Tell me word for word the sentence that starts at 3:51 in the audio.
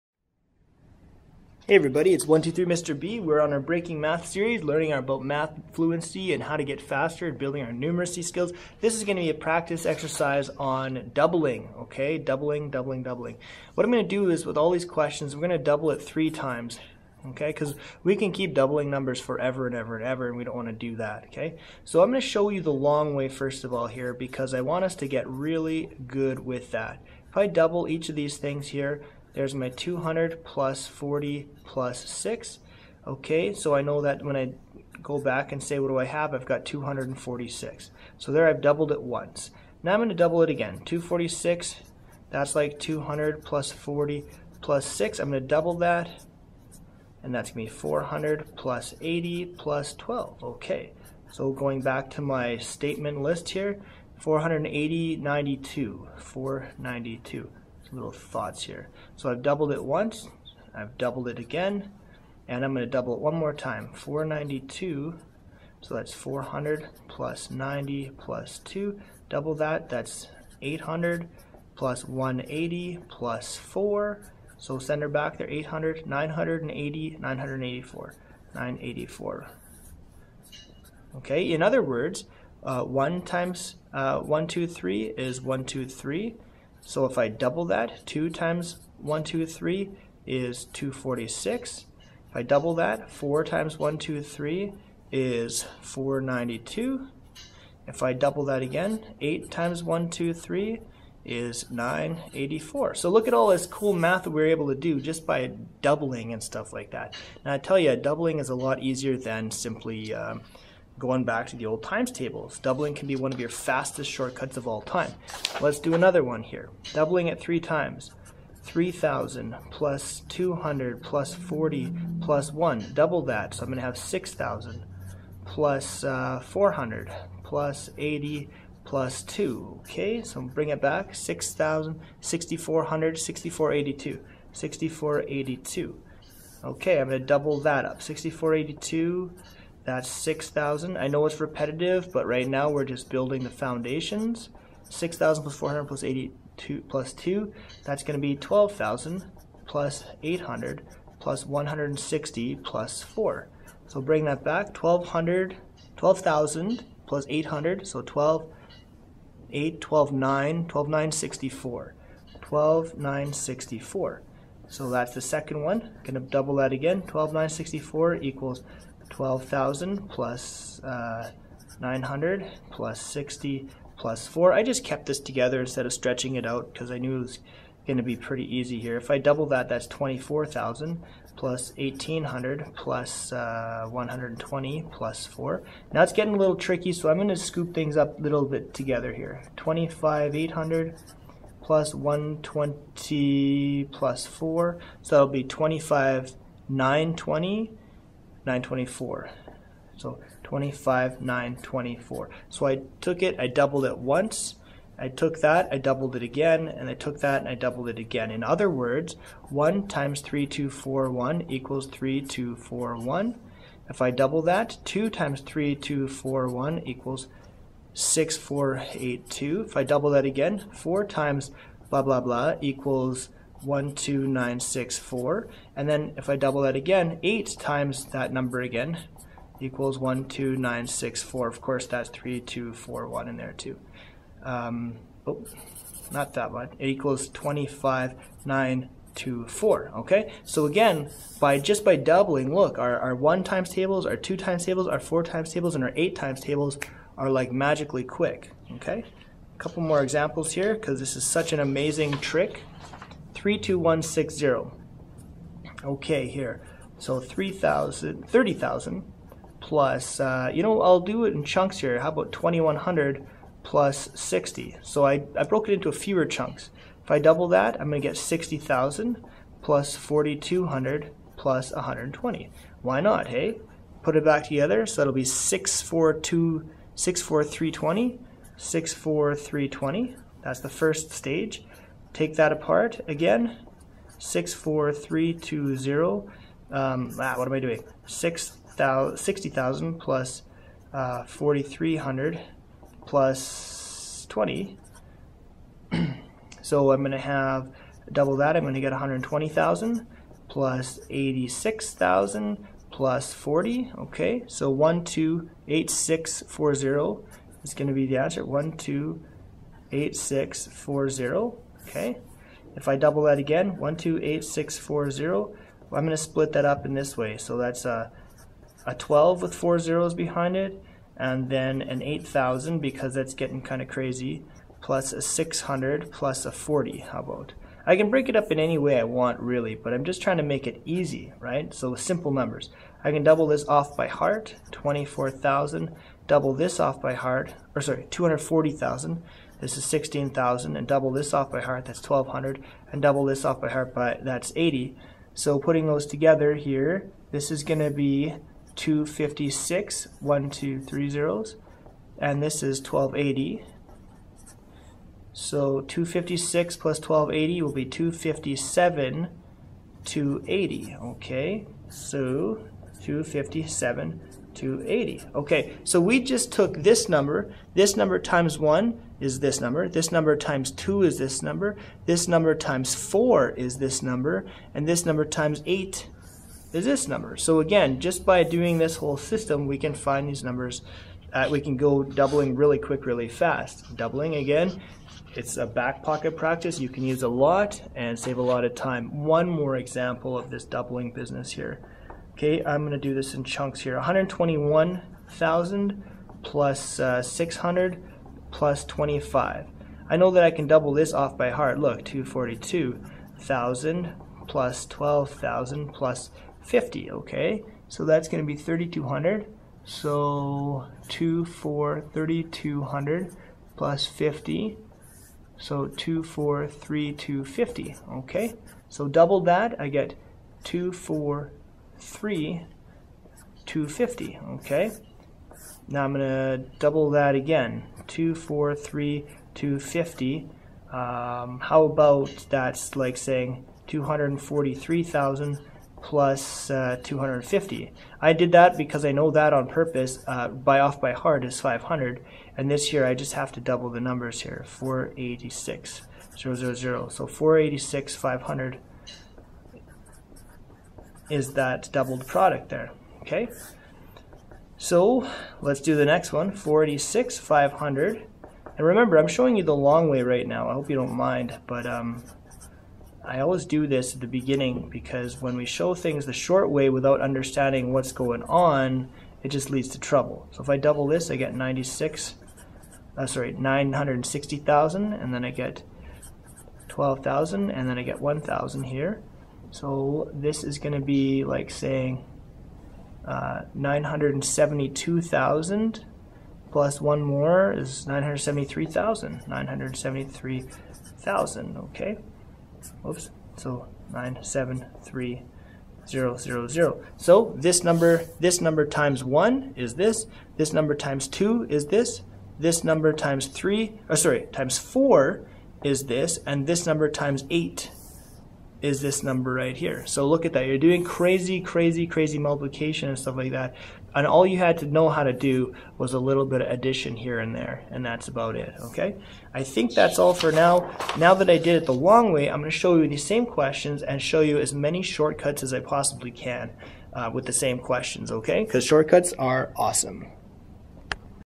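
Of course, that's 3241 in there too.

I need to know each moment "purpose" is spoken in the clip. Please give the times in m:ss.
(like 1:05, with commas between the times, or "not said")
7:19.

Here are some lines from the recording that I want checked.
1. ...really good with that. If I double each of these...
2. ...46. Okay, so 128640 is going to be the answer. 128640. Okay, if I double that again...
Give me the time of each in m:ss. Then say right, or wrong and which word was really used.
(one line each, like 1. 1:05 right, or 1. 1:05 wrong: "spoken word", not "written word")
1. 0:25 right
2. 5:03 wrong: "40", not "46".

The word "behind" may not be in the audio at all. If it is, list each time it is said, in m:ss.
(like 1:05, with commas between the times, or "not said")
5:20.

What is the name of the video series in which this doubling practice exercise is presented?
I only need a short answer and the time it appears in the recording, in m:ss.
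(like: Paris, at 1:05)
Breaking Math, at 0:03.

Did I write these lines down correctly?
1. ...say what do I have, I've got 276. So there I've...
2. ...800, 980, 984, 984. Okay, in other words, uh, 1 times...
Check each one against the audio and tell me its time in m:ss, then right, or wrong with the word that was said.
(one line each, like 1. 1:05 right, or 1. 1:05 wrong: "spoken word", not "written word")
1. 0:35 wrong: "246", not "276"
2. 1:15 right.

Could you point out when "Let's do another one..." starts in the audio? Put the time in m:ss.
1:55.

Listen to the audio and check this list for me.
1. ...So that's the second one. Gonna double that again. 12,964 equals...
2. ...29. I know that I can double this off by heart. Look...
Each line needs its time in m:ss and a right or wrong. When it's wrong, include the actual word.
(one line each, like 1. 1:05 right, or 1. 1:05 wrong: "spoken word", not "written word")
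1. 2:44 right
2. 6:38 wrong: "25", not "29".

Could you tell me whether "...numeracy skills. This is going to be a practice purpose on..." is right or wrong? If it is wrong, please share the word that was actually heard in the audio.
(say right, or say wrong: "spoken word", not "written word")
wrong: "exercise", not "purpose".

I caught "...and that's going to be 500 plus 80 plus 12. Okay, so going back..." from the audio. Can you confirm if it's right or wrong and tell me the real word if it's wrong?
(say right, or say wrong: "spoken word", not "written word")
wrong: "400", not "500".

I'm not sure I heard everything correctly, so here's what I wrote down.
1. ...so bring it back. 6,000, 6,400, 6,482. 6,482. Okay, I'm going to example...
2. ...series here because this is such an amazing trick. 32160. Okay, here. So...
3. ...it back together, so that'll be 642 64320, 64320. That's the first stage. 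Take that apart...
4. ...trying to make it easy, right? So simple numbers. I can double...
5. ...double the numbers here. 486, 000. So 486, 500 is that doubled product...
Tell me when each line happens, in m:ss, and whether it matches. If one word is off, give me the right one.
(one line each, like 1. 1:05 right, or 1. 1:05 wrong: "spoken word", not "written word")
1. 2:10 wrong: "double", not "example"
2. 4:10 wrong: "examples", not "series"
3. 4:34 right
4. 5:30 right
5. 7:23 right.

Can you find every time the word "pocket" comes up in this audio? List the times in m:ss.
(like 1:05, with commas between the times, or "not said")
6:26.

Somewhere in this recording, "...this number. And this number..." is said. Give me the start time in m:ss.
6:13.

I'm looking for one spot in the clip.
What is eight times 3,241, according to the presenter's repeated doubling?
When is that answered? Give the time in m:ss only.
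3:56.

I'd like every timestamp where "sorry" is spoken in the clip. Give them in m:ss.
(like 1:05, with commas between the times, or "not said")
5:37, 7:53, 8:24.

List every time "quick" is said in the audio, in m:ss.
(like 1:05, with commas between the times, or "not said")
4:08, 6:22.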